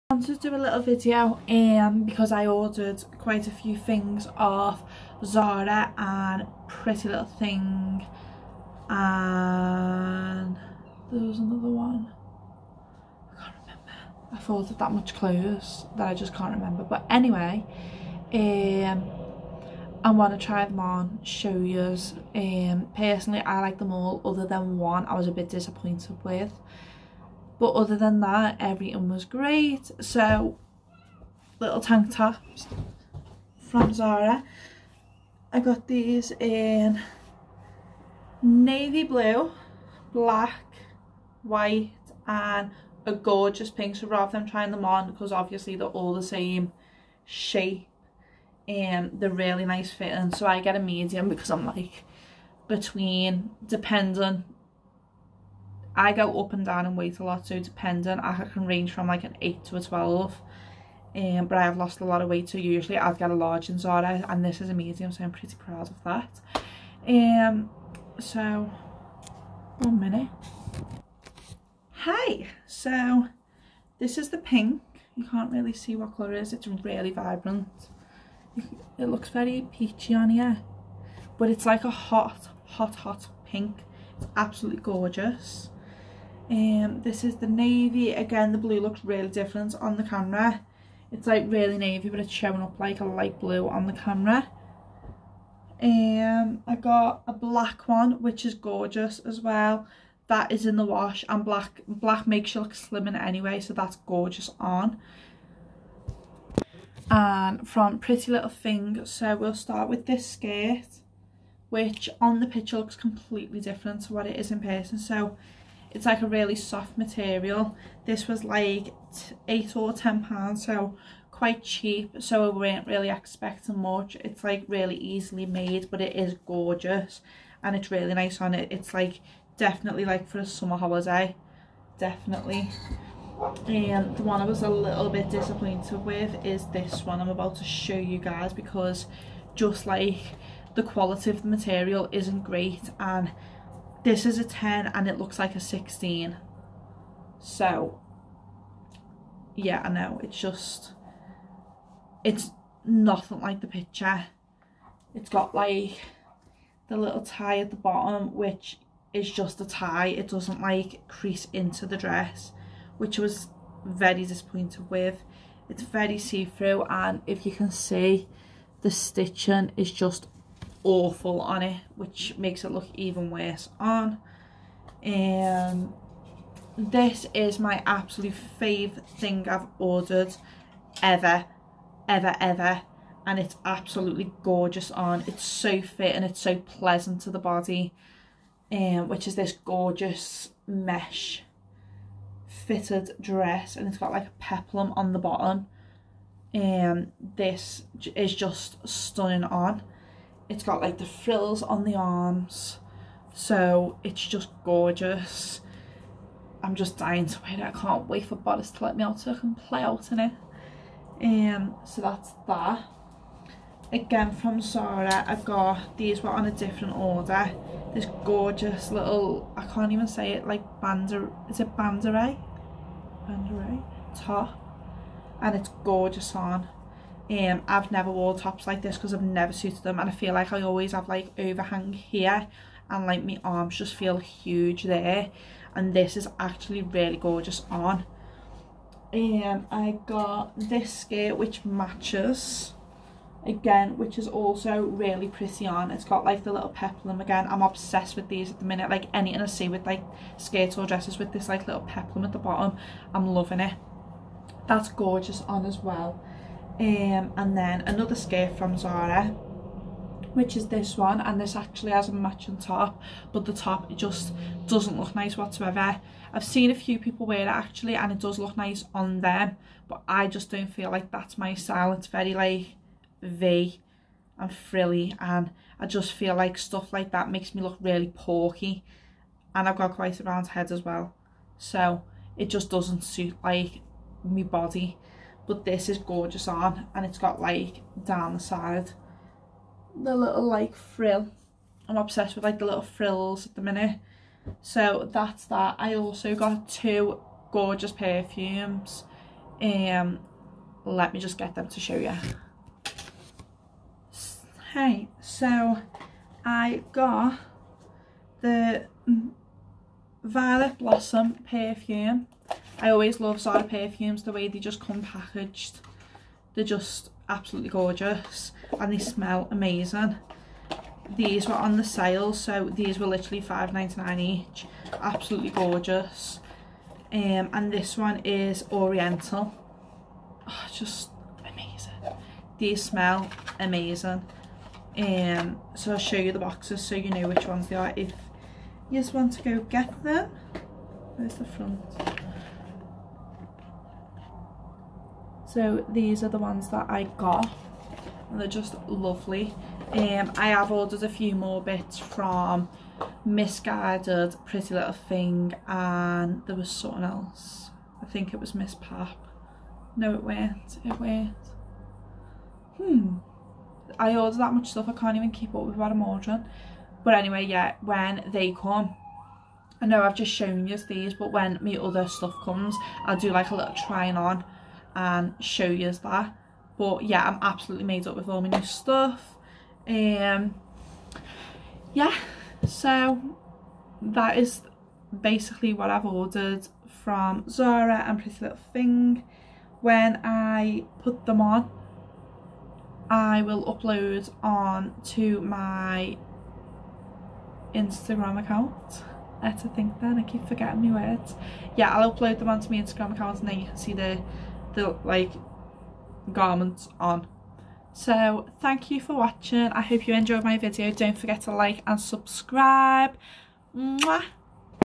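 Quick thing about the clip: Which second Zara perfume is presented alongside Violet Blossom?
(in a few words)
Oriental.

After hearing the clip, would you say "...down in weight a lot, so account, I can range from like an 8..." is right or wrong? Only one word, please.
wrong.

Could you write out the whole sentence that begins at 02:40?
It doesn't like crease into the dress, which was very disappointed with.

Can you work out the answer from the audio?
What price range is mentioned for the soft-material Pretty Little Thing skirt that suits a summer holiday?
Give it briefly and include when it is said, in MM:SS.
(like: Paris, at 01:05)
8 or 10 pounds, at 01:59.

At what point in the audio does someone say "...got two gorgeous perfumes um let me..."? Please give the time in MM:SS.
04:56.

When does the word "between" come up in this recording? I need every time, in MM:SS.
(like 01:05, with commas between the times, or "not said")
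00:52.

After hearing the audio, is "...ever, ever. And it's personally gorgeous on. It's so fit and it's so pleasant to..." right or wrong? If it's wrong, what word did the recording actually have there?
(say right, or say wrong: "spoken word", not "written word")
wrong: "absolutely", not "personally".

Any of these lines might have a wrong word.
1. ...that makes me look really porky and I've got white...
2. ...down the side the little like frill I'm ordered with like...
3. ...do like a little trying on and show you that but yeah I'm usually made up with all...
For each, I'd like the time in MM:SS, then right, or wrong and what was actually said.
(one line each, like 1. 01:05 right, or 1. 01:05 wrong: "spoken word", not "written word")
1. 04:37 wrong: "quite", not "white"
2. 04:48 wrong: "obsessed", not "ordered"
3. 06:13 wrong: "absolutely", not "usually".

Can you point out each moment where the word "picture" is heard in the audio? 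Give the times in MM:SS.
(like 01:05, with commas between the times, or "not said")
01:52, 02:33.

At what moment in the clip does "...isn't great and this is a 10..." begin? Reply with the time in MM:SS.
02:22.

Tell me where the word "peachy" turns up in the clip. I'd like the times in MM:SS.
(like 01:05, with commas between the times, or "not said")
01:19.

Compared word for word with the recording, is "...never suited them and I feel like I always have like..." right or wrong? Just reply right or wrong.
right.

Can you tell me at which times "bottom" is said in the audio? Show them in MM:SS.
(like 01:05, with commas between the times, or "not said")
02:37, 03:15, 04:12.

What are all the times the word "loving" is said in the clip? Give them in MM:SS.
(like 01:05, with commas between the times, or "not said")
04:13.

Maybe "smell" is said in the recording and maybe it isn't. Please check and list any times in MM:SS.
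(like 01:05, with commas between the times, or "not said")
05:18, 05:32.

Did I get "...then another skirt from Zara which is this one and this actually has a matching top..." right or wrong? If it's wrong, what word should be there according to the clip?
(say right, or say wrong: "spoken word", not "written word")
right.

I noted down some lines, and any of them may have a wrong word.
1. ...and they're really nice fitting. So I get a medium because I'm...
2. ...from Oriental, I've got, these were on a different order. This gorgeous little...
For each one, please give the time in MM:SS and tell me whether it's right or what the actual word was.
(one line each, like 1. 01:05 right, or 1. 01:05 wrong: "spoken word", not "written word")
1. 00:48 right
2. 03:34 wrong: "Zara", not "Oriental".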